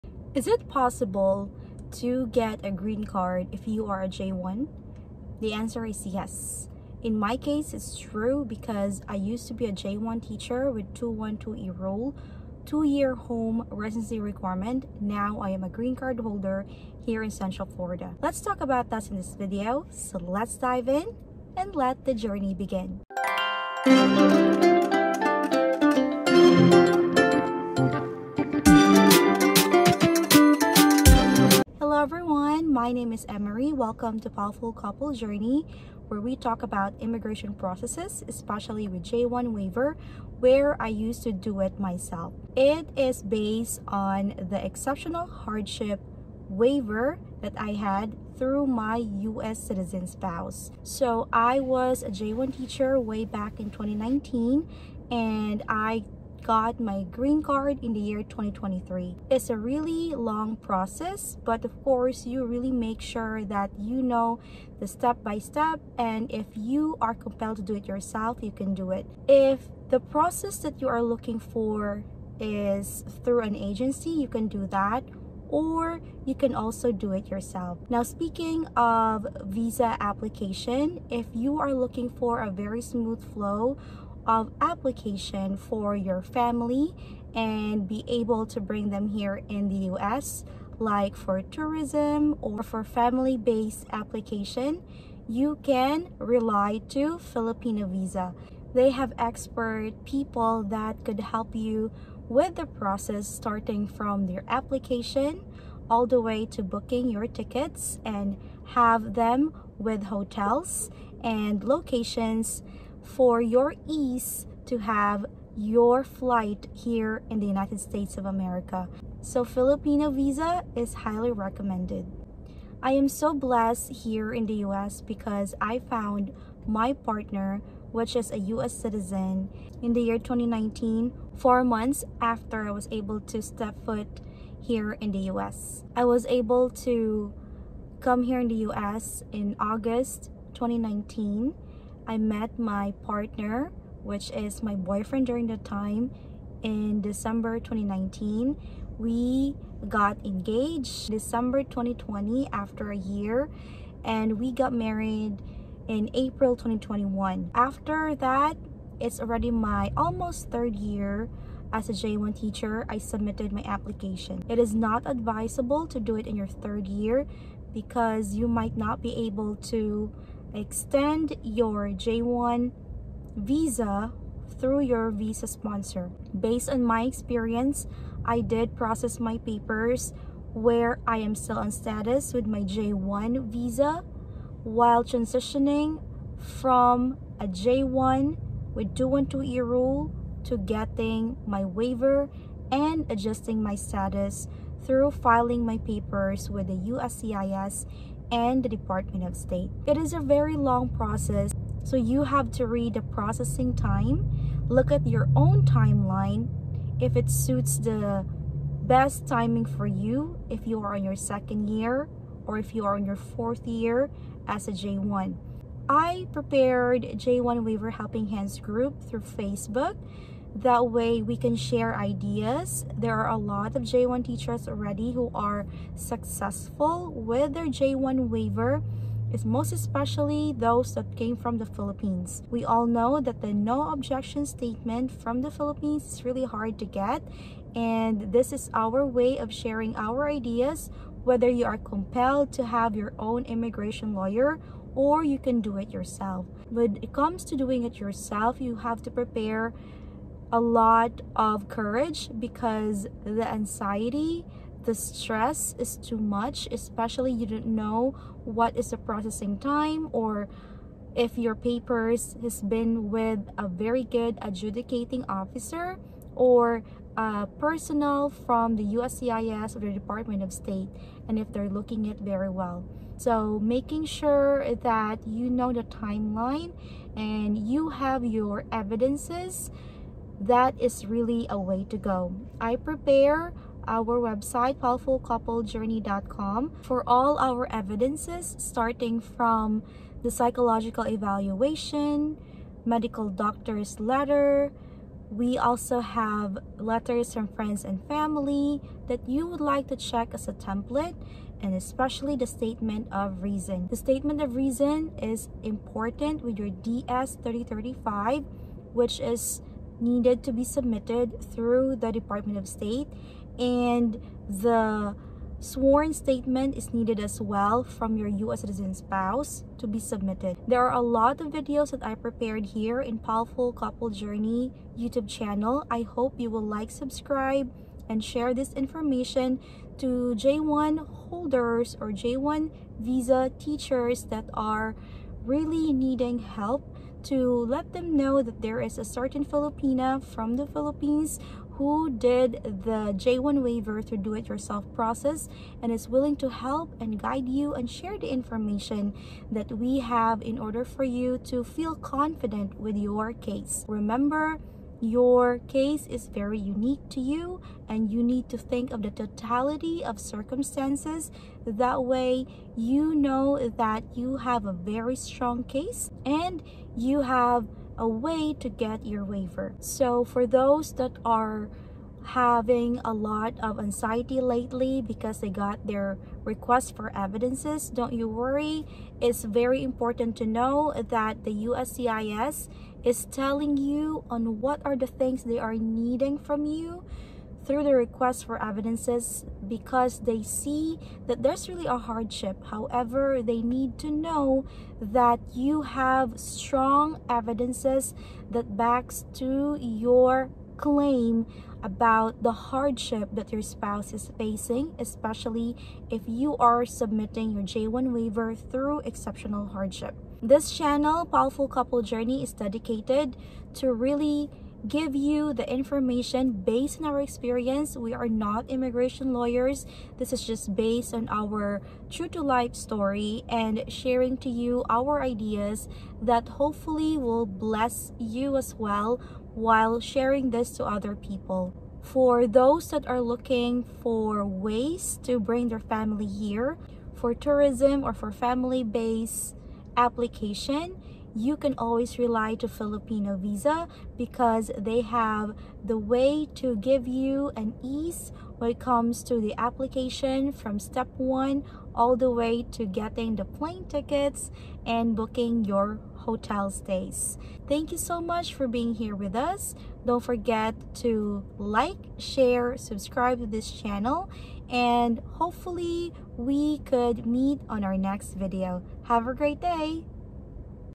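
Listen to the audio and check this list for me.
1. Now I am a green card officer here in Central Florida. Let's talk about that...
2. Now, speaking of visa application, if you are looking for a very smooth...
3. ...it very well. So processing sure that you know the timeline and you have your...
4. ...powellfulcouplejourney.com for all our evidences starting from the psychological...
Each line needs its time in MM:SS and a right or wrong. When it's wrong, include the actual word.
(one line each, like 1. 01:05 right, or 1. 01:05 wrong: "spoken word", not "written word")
1. 00:15 wrong: "holder", not "officer"
2. 01:17 right
3. 04:32 wrong: "making", not "processing"
4. 04:44 right.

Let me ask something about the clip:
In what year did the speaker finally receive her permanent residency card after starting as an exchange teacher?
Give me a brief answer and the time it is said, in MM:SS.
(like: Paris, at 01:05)
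2023, at 00:58.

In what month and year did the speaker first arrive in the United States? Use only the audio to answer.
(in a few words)
August 2019.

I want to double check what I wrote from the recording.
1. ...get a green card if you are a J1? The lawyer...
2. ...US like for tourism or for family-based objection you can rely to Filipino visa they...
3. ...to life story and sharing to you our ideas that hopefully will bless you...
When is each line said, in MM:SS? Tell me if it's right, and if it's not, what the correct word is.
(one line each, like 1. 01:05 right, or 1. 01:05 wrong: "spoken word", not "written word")
1. 00:02 wrong: "answer", not "lawyer"
2. 01:29 wrong: "application", not "objection"
3. 07:02 right.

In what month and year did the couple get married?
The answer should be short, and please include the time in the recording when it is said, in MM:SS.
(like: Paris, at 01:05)
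April 2021, at 02:36.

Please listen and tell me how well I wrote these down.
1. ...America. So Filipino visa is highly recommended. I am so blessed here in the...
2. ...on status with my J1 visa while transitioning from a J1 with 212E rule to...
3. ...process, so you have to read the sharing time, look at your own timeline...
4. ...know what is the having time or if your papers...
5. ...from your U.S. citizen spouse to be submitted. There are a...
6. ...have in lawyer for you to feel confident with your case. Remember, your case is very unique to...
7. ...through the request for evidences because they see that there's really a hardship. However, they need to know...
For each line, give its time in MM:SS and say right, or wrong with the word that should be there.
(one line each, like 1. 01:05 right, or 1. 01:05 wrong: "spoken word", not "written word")
1. 01:58 right
2. 03:01 right
3. 03:20 wrong: "processing", not "sharing"
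4. 04:17 wrong: "processing", not "having"
5. 05:17 right
6. 05:49 wrong: "order", not "lawyer"
7. 06:27 right.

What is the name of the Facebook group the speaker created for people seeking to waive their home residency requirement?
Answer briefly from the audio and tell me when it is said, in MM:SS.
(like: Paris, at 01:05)
J1 Waiver Helping Hands, at 03:37.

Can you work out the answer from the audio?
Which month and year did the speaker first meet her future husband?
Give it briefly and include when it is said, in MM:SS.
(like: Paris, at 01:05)
December 2019, at 02:26.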